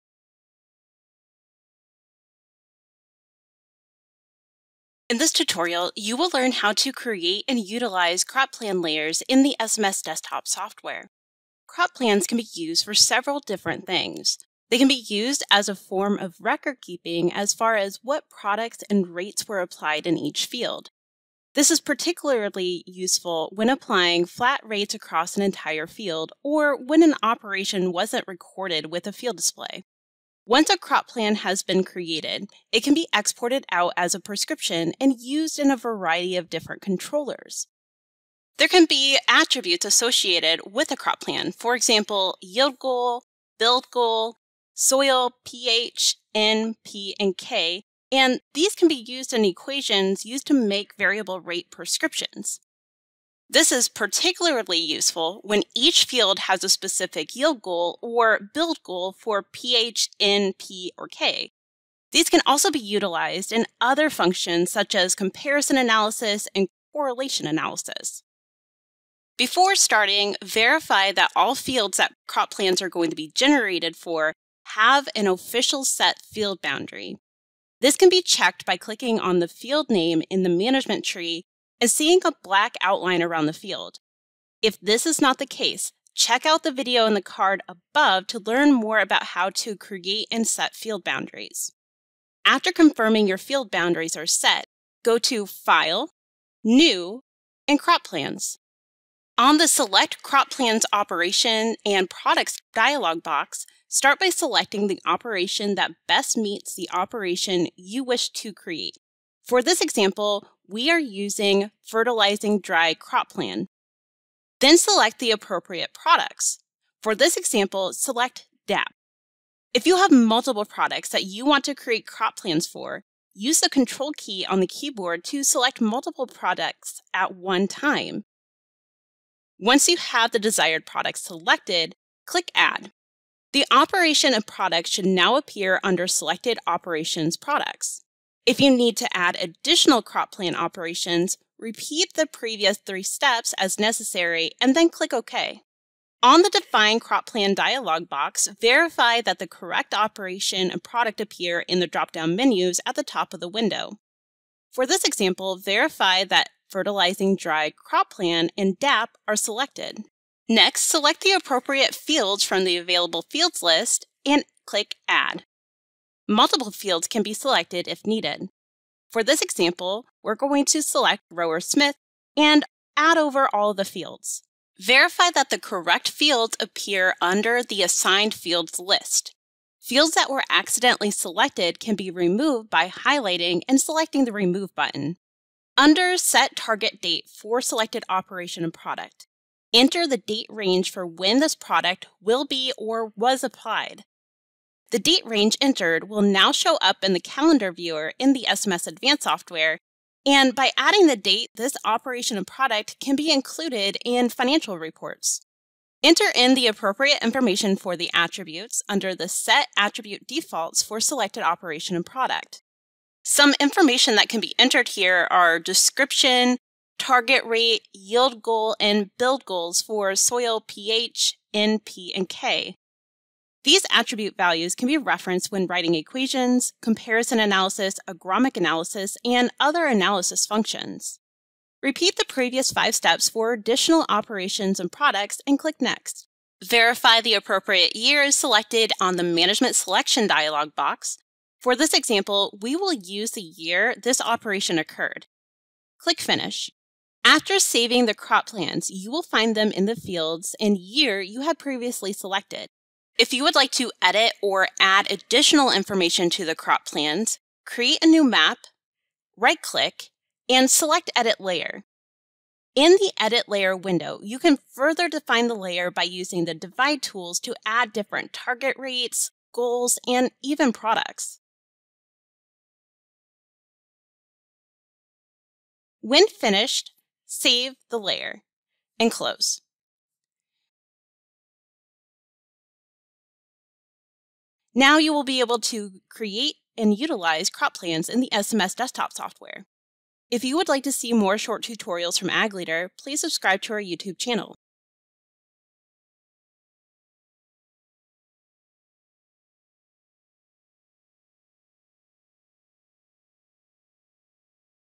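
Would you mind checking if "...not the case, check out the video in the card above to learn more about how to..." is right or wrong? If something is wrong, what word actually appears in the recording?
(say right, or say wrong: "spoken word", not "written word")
right.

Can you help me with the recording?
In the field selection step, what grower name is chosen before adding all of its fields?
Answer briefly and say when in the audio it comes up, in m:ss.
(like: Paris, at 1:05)
Rower Smith, at 2:51.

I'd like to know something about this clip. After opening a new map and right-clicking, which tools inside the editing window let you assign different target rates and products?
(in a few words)
Divide tools.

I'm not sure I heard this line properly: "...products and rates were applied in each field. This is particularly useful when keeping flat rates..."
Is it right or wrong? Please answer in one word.
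wrong.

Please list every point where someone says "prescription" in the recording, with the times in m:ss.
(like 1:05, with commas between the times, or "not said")
0:34, 0:51.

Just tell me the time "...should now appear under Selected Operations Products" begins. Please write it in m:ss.
2:14.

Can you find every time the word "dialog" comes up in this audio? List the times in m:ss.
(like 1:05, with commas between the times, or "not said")
1:42, 2:27, 4:00.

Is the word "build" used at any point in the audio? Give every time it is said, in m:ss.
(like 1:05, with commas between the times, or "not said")
0:43, 0:58, 3:39.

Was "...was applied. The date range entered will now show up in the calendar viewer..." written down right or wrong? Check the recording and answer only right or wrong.
right.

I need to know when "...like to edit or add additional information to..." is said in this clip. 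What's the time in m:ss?
4:13.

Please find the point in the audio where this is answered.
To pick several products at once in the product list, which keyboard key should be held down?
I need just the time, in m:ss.
2:03.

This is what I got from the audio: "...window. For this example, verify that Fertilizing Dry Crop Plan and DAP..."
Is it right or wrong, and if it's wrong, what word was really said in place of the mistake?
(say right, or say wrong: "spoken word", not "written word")
right.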